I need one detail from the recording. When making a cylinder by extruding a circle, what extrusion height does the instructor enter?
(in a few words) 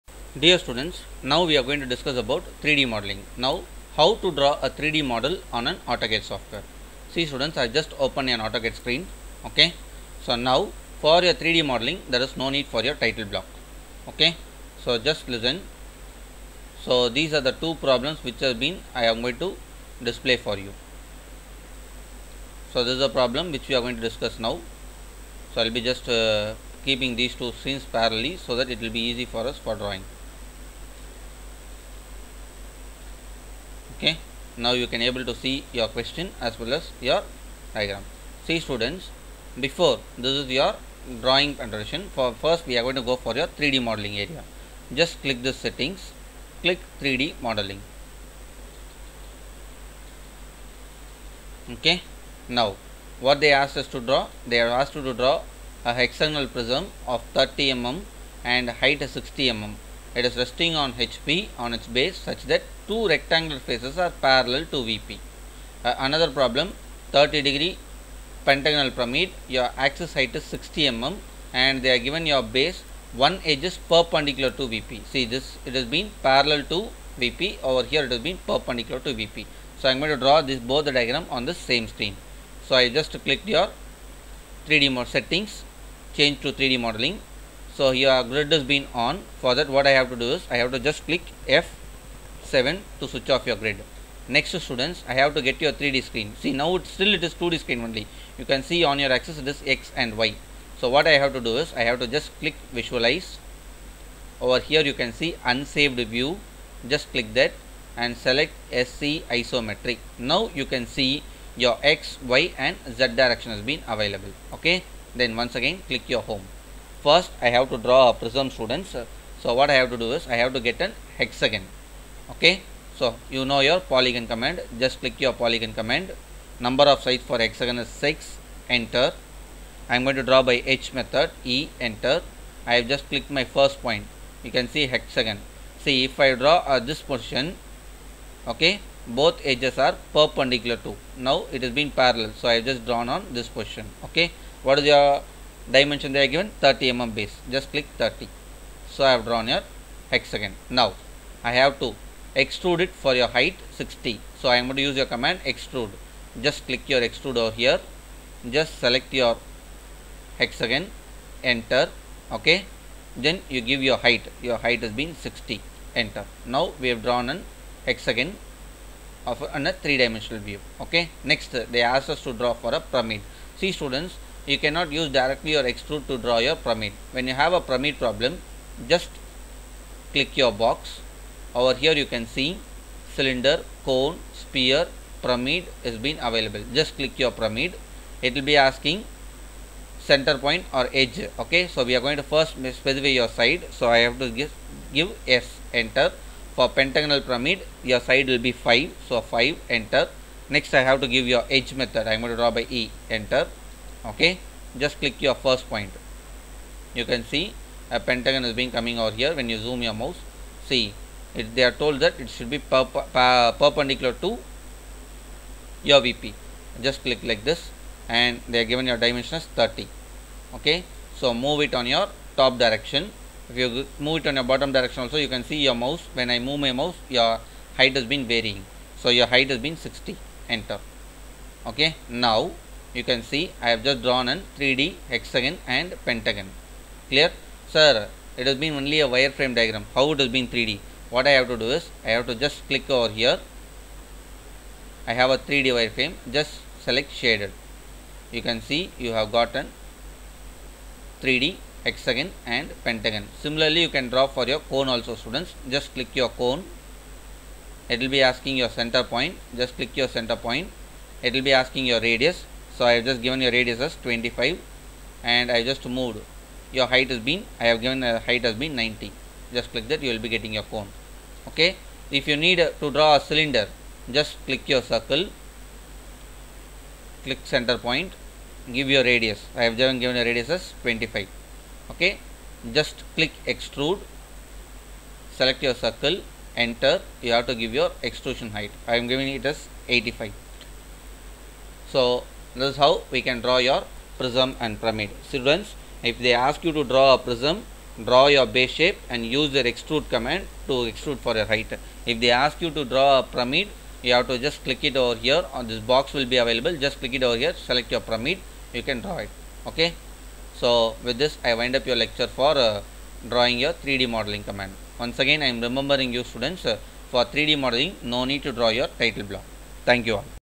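85.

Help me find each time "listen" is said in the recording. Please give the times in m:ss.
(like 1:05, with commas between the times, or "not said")
0:15.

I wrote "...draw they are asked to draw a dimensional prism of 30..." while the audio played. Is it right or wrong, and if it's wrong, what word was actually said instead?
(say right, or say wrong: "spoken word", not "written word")
wrong: "hexagonal", not "dimensional".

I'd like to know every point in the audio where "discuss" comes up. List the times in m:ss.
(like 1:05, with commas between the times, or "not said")
0:01, 0:24.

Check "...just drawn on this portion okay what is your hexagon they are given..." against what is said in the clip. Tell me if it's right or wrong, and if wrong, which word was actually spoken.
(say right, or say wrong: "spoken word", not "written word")
wrong: "dimension", not "hexagon".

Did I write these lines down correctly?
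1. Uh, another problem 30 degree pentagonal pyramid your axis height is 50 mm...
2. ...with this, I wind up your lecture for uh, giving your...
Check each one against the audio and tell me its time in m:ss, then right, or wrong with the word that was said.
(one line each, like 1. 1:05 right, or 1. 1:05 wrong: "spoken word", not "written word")
1. 1:05 wrong: "60", not "50"
2. 5:11 wrong: "drawing", not "giving".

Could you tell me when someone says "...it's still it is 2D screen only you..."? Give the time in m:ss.
1:36.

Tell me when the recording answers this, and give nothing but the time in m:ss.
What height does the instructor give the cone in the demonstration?
4:28.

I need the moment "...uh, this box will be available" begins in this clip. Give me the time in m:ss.
5:05.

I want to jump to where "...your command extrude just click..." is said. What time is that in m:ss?
2:34.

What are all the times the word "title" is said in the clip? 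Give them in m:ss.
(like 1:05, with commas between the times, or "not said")
0:12, 5:18.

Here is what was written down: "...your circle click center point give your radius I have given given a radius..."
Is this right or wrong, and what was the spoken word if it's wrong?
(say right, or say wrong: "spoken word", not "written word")
right.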